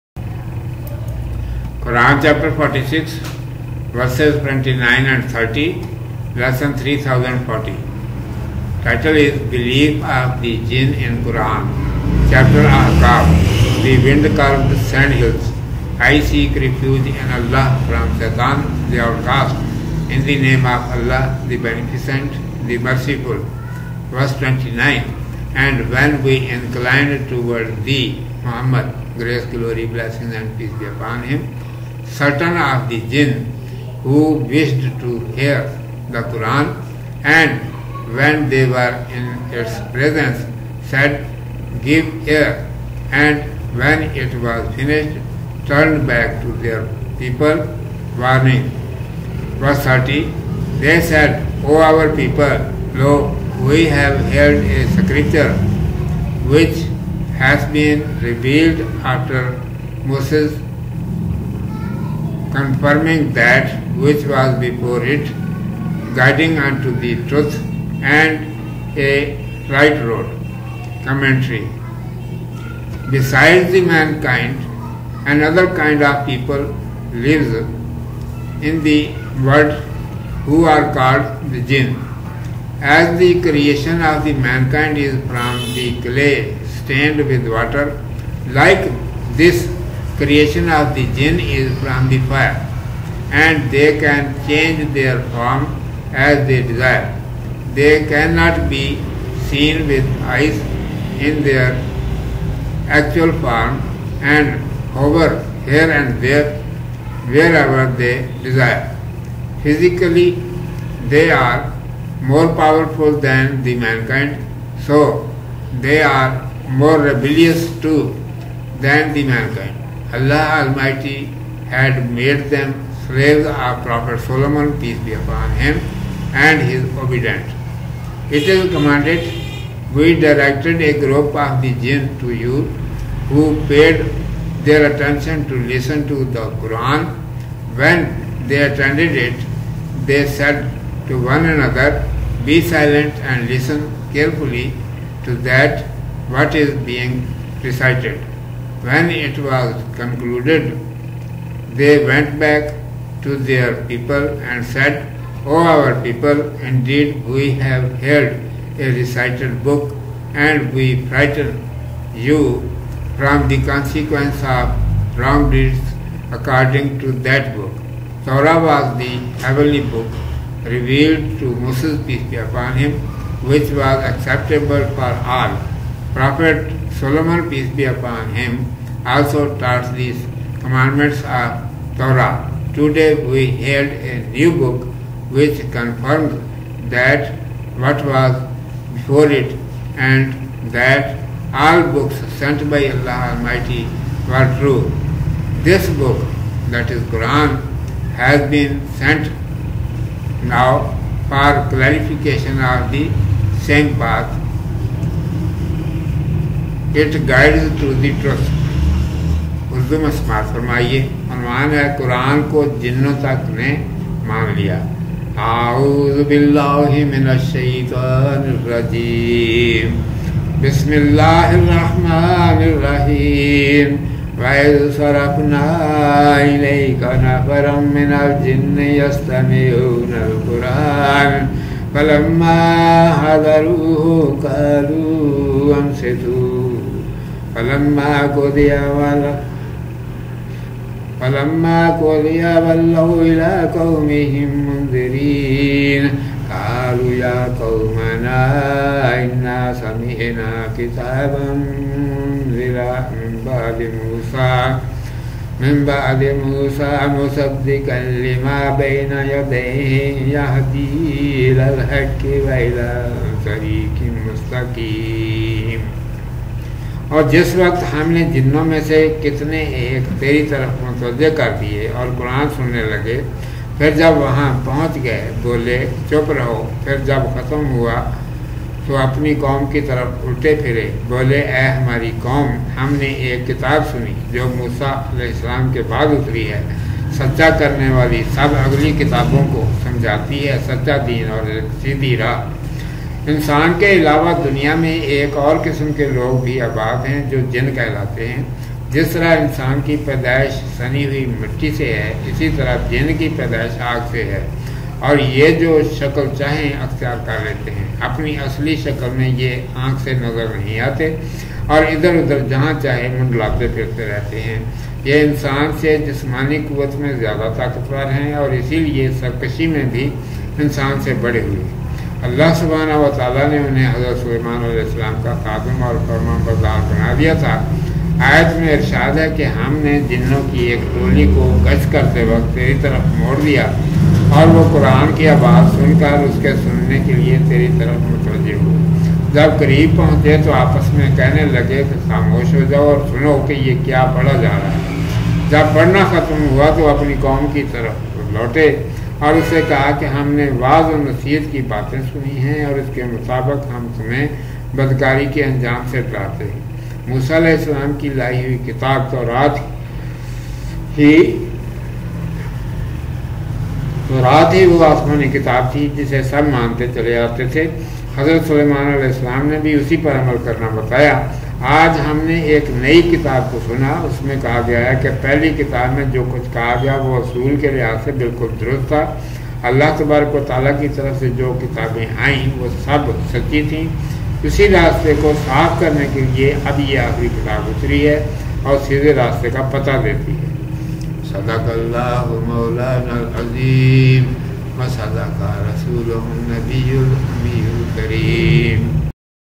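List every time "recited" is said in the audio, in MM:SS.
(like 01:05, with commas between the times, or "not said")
02:27, 02:38.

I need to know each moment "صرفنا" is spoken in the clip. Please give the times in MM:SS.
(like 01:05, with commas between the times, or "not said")
03:44.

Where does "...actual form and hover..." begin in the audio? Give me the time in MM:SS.
01:42.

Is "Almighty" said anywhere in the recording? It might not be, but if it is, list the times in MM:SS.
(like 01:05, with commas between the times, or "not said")
02:00, 03:13.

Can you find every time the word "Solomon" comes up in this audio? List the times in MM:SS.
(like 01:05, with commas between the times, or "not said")
02:04, 02:56.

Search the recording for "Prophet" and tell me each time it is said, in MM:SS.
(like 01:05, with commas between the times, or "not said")
02:03, 02:56.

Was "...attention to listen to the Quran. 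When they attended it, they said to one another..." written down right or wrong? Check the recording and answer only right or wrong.
right.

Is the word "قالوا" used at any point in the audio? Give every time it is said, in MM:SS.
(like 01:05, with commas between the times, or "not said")
03:54, 04:06.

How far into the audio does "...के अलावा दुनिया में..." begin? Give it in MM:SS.
04:53.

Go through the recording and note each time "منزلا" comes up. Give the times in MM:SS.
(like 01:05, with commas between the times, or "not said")
04:11.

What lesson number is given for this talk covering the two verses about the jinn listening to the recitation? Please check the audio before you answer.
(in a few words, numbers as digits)
3040.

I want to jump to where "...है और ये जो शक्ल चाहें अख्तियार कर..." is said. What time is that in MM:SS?
05:04.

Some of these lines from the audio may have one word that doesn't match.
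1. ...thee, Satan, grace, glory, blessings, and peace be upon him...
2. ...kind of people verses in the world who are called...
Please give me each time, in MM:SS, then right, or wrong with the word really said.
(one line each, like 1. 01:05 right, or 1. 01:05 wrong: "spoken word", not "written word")
1. 00:27 wrong: "Muhammad", not "Satan"
2. 01:15 wrong: "lives", not "verses".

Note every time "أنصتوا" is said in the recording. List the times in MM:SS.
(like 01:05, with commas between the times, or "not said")
03:55.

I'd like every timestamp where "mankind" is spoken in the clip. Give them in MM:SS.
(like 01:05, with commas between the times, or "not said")
01:13, 01:24, 01:53, 01:59.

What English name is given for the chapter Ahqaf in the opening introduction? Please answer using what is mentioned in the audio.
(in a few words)
the wind curved sand hills.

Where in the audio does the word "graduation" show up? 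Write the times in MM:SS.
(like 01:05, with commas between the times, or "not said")
not said.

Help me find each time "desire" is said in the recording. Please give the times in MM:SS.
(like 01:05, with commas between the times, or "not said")
01:36, 01:48.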